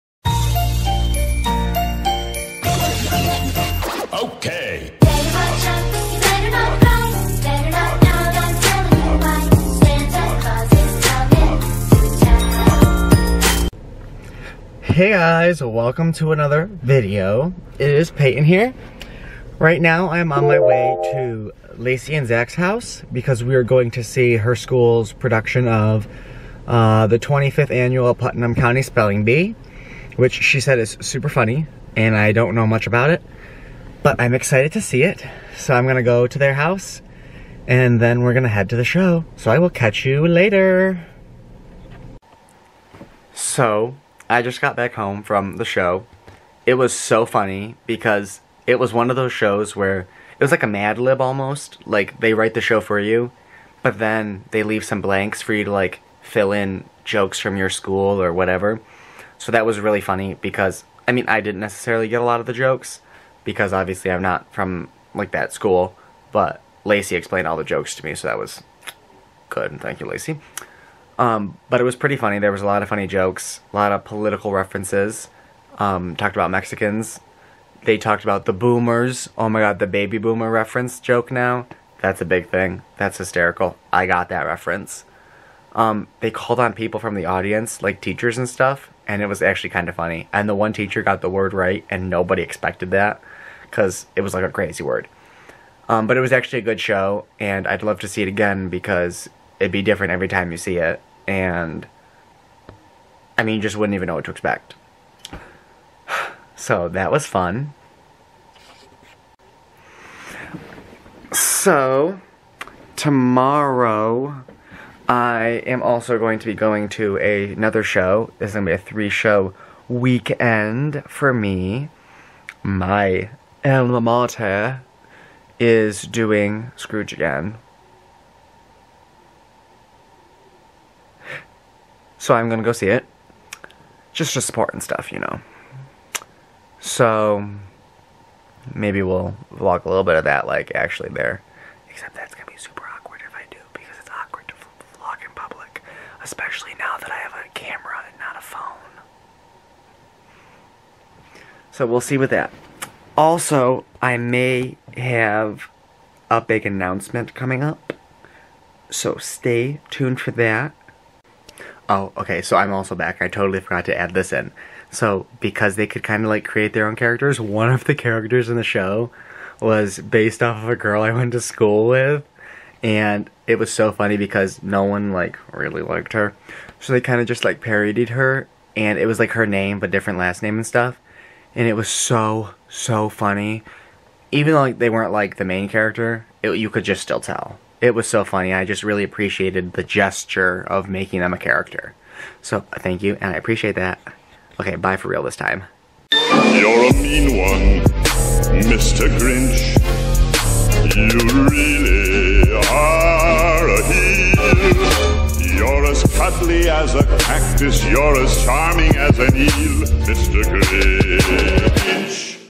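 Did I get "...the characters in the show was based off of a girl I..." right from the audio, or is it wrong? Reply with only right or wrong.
right.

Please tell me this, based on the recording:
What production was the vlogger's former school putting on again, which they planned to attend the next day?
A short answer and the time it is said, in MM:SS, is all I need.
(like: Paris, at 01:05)
Scrooge, at 02:06.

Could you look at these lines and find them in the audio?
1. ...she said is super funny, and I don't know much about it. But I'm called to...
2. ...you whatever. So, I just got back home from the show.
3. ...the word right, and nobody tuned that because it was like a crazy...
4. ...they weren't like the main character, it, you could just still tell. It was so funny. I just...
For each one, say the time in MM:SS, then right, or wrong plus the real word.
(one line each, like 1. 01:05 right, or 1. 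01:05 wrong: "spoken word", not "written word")
1. 00:30 wrong: "excited", not "called"
2. 00:40 wrong: "later", not "whatever"
3. 01:31 wrong: "expected", not "tuned"
4. 03:04 right.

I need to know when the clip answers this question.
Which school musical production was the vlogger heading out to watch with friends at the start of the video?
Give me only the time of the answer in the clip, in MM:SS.
00:27.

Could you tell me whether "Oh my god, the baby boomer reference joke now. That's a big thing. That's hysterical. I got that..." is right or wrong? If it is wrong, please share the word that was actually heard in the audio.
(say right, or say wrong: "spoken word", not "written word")
right.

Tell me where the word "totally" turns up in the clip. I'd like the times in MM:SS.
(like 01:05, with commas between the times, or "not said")
02:43.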